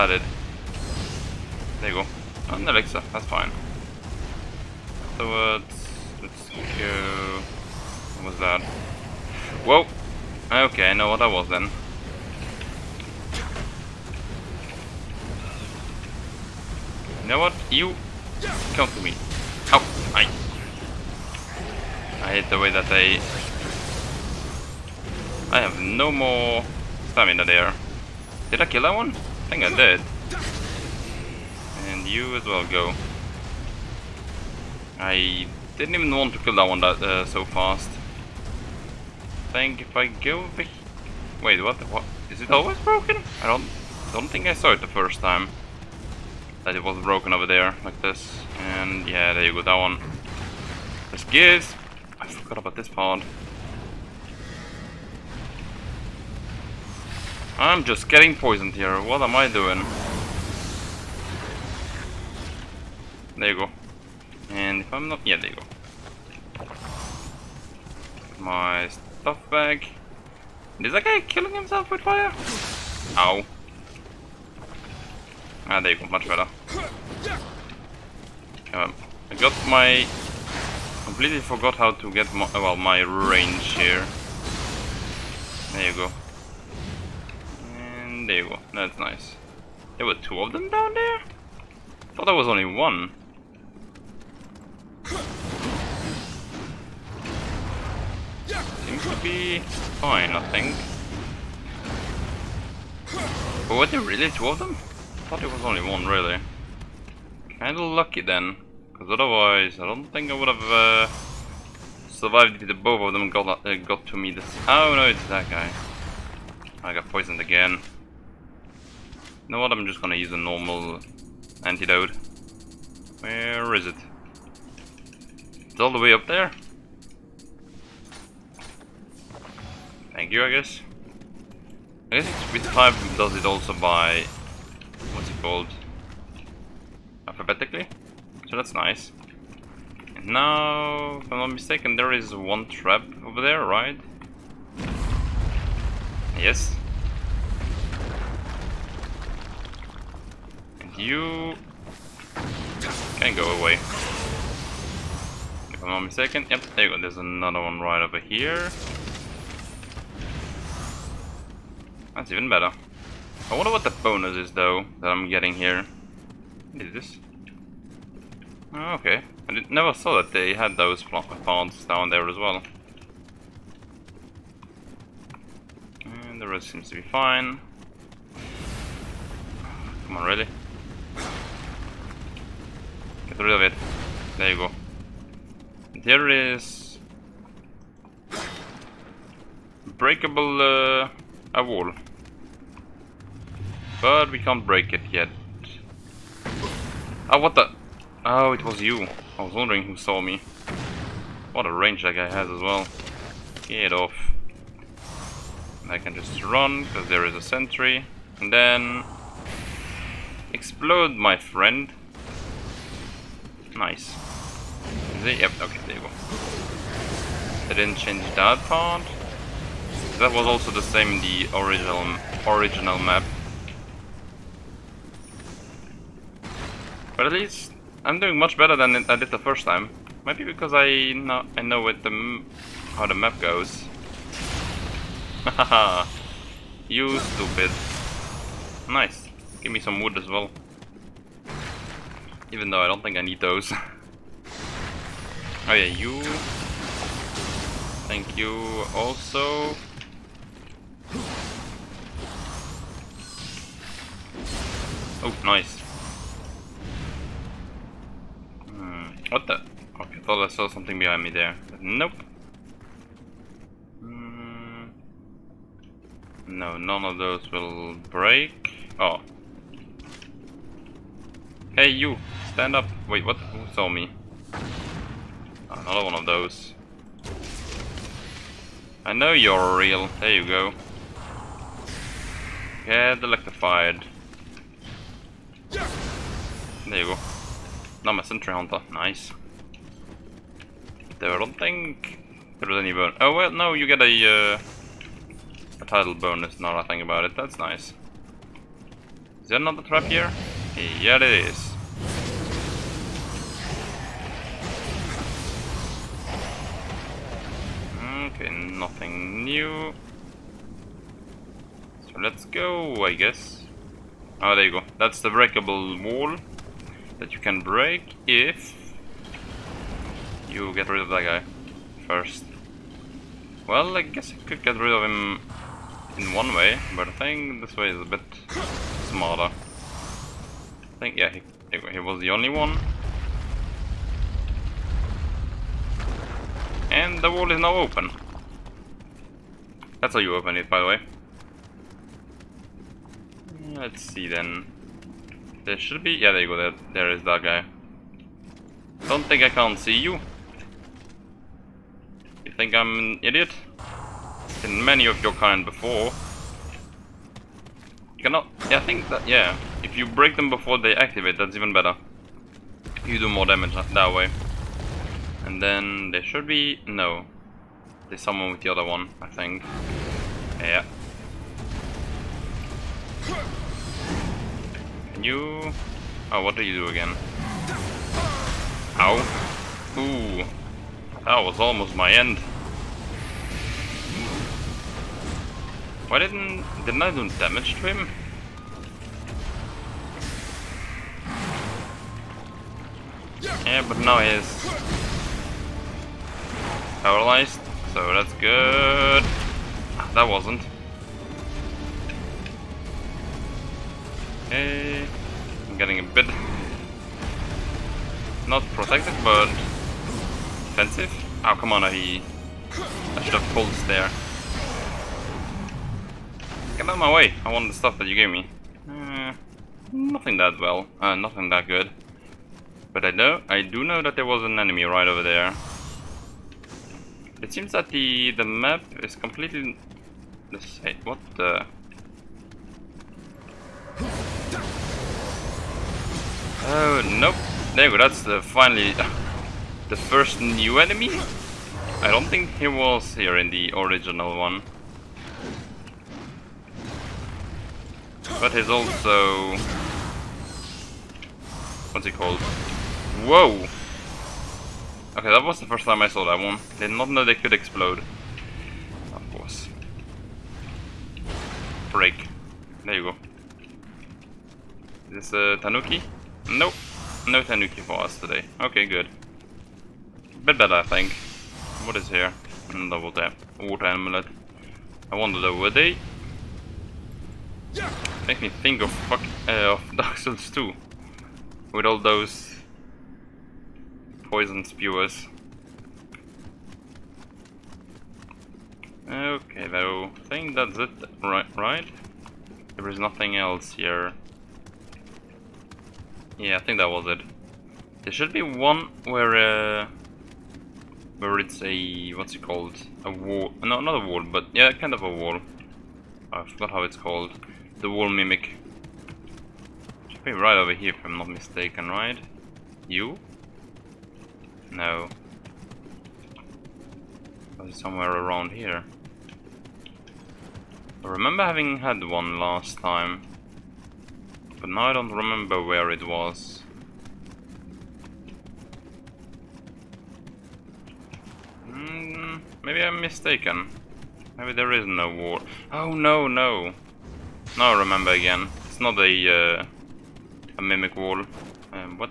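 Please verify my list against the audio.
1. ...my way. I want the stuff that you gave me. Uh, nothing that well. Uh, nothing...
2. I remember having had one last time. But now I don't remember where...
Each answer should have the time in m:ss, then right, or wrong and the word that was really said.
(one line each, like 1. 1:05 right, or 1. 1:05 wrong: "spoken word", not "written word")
1. 6:56 right
2. 8:41 right.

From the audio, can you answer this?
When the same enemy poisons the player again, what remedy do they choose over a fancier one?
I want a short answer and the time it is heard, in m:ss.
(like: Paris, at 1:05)
normal antidote, at 2:00.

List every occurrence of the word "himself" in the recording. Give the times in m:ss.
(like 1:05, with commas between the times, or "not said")
1:11.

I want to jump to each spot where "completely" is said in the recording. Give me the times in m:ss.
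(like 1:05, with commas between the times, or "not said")
1:21, 7:09.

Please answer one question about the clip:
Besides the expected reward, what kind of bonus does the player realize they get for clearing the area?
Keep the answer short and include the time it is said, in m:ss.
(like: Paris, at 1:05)
title bonus, at 4:55.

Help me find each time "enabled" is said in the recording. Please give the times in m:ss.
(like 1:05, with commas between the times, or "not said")
not said.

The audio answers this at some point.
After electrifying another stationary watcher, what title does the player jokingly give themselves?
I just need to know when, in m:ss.
4:48.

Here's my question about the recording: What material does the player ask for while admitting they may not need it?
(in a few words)
wood.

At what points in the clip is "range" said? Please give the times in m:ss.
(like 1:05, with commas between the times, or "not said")
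1:23, 3:21.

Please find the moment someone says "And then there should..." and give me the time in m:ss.
6:05.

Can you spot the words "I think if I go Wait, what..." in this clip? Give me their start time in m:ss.
0:39.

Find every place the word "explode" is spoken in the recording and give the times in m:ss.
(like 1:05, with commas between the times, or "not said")
3:30, 7:37.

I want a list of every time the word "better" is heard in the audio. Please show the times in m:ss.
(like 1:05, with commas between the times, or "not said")
1:16, 2:42, 3:48, 6:01, 7:50.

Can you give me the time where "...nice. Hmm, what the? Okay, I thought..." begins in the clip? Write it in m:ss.
4:15.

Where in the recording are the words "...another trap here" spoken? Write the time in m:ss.
4:59.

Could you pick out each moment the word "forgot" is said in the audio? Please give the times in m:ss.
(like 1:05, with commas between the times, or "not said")
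0:52, 1:21, 8:26.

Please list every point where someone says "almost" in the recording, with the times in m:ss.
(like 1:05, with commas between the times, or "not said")
6:21.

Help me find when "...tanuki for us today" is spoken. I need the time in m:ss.
7:47.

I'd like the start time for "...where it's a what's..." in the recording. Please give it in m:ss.
8:21.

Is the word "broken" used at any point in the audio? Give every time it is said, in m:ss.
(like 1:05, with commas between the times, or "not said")
0:42, 0:47.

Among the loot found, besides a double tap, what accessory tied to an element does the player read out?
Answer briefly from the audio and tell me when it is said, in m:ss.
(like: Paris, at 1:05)
Water amulet, at 7:53.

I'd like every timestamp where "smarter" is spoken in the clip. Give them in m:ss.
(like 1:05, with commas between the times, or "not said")
5:29.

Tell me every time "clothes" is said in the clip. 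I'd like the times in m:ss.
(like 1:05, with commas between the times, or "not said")
not said.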